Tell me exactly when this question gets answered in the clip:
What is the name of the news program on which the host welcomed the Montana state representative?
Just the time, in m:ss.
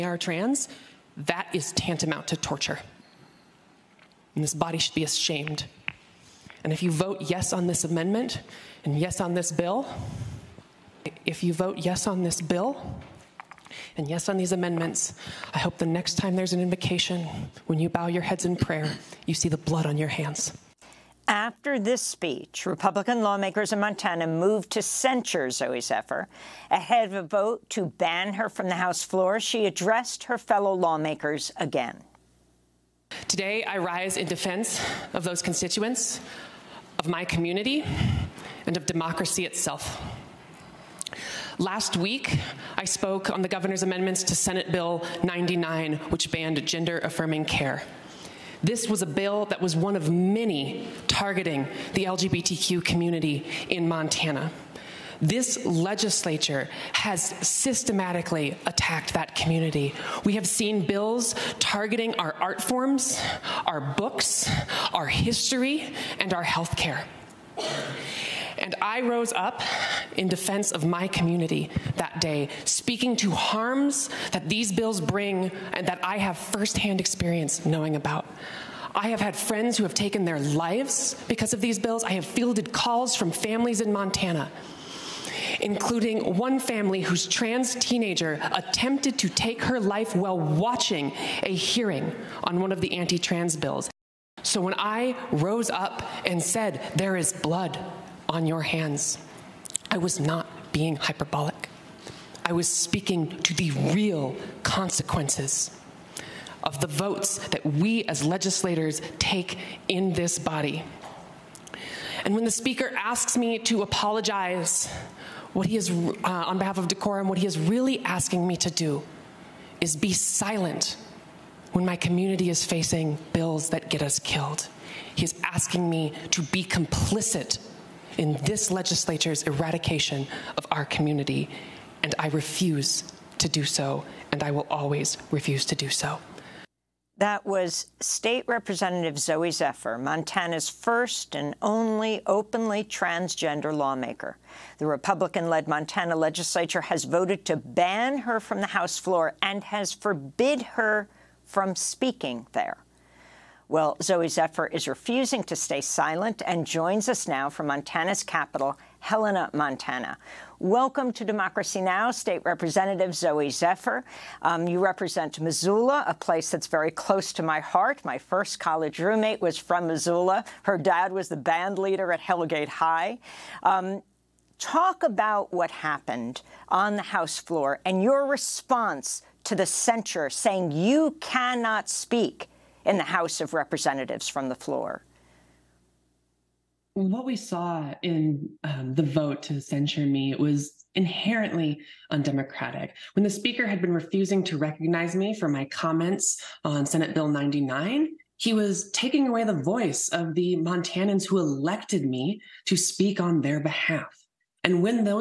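2:41.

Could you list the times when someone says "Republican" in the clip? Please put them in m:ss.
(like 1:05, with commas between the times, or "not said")
0:22, 2:24.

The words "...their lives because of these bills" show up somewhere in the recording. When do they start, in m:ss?
1:20.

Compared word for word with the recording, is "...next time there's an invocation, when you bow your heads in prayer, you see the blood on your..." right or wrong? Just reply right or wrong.
right.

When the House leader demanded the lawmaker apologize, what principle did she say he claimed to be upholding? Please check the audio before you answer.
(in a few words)
Decorum.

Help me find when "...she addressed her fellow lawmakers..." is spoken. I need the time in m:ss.
0:29.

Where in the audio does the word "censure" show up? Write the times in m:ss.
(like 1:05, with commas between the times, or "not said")
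0:24, 2:59, 3:09.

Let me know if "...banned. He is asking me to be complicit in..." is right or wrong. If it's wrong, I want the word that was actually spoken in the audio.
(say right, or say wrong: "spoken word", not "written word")
wrong: "killed", not "banned".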